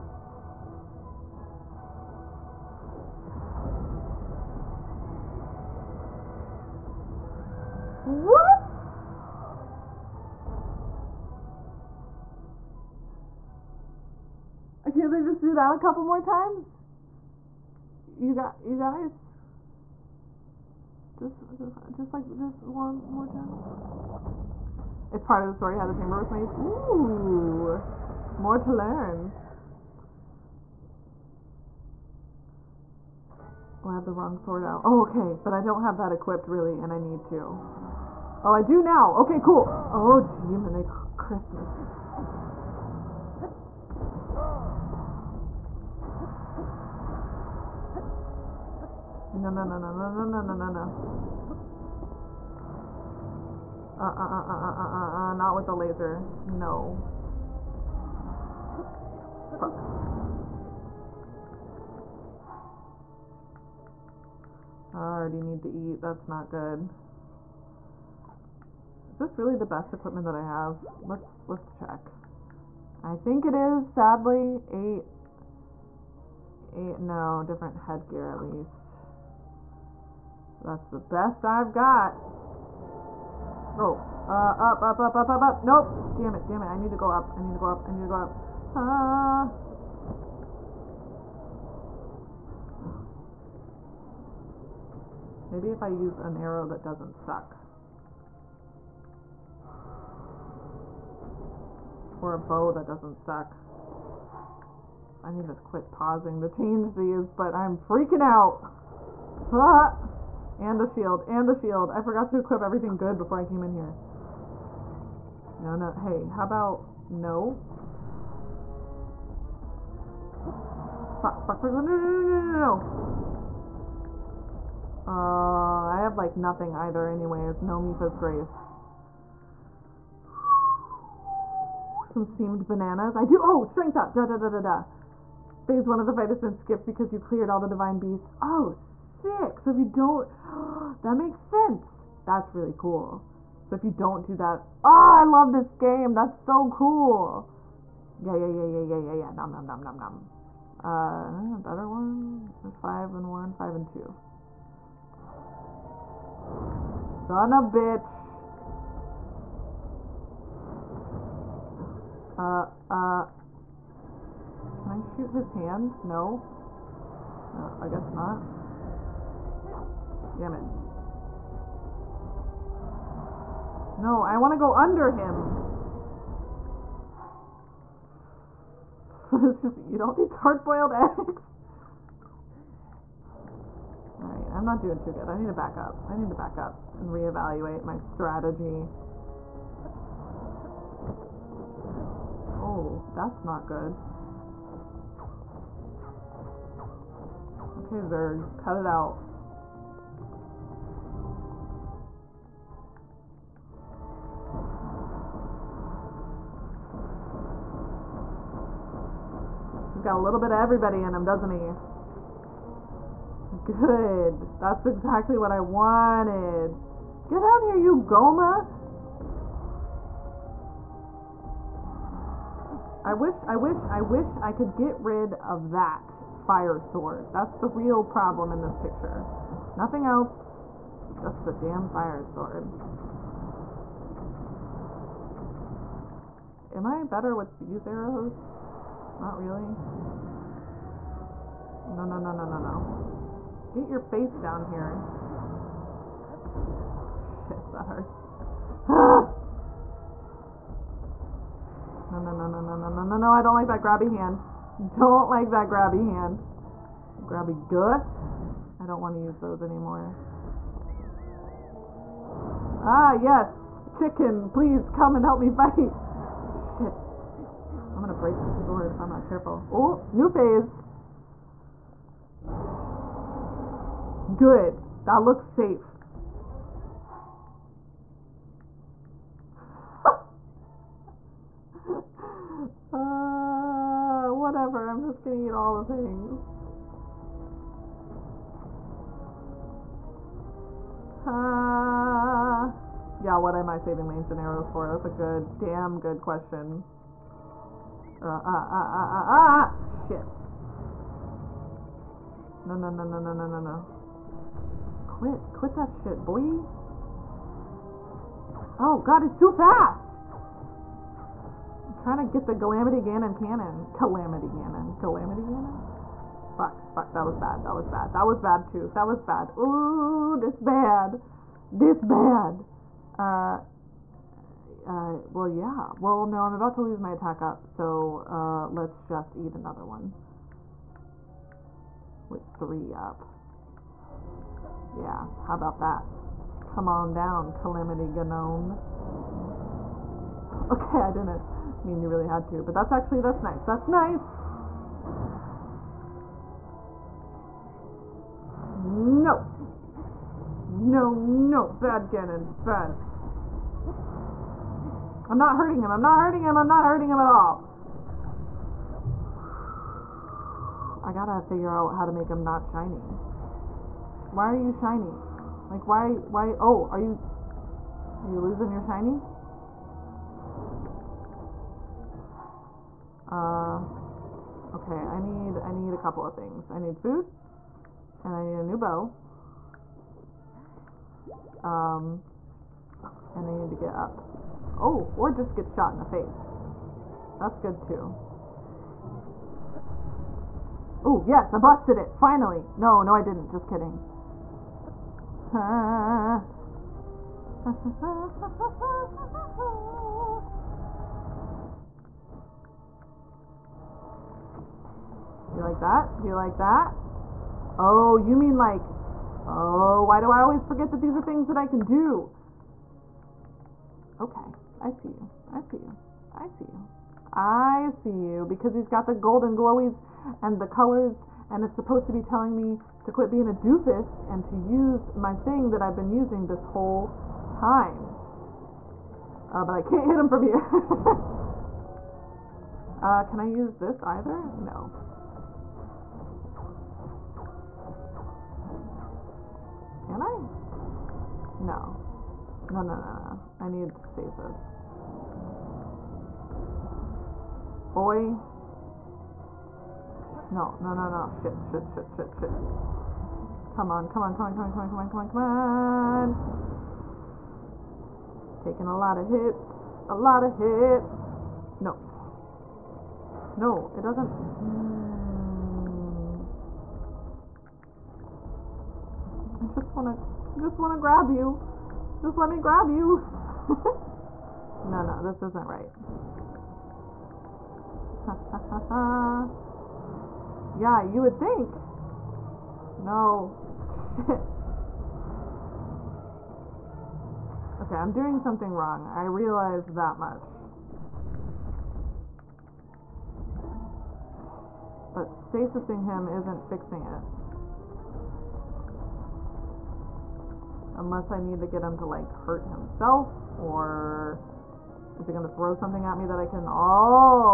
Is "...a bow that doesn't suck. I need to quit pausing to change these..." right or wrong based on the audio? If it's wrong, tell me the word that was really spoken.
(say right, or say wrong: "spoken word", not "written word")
right.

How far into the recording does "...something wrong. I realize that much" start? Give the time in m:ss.
8:08.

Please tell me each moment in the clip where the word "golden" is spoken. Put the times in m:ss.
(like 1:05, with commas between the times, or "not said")
6:59.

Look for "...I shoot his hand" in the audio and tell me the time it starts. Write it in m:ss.
2:44.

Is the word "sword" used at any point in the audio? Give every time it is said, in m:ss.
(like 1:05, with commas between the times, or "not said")
0:34, 3:46, 3:52, 4:28.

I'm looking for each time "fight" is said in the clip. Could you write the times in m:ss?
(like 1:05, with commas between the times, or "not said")
2:16, 4:25.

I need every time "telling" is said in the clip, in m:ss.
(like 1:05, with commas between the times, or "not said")
7:02.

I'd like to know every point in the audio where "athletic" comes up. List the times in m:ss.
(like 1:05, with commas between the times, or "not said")
not said.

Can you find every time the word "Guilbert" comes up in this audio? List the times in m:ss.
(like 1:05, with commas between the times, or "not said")
not said.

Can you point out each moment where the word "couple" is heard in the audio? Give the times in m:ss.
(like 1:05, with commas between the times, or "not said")
0:15, 6:15.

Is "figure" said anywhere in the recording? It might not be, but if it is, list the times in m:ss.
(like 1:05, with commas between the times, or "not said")
6:01.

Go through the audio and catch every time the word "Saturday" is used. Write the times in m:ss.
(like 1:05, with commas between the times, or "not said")
not said.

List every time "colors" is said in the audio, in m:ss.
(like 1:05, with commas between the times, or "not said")
7:00.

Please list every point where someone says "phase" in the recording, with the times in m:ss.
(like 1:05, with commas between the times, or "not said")
2:15, 4:30.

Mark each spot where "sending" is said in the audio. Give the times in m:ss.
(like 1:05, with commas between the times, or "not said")
not said.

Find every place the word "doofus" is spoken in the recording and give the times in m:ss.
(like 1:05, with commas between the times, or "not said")
7:03.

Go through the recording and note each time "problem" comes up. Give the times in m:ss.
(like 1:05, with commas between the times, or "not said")
3:48.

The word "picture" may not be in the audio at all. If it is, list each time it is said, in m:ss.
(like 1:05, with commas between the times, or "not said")
3:48.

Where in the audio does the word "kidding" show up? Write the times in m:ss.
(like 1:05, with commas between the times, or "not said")
6:33.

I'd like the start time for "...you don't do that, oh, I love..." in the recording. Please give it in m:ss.
2:23.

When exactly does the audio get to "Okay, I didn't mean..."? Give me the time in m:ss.
5:40.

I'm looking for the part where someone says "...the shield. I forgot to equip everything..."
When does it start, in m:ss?
1:51.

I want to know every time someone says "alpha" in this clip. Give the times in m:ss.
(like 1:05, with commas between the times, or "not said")
not said.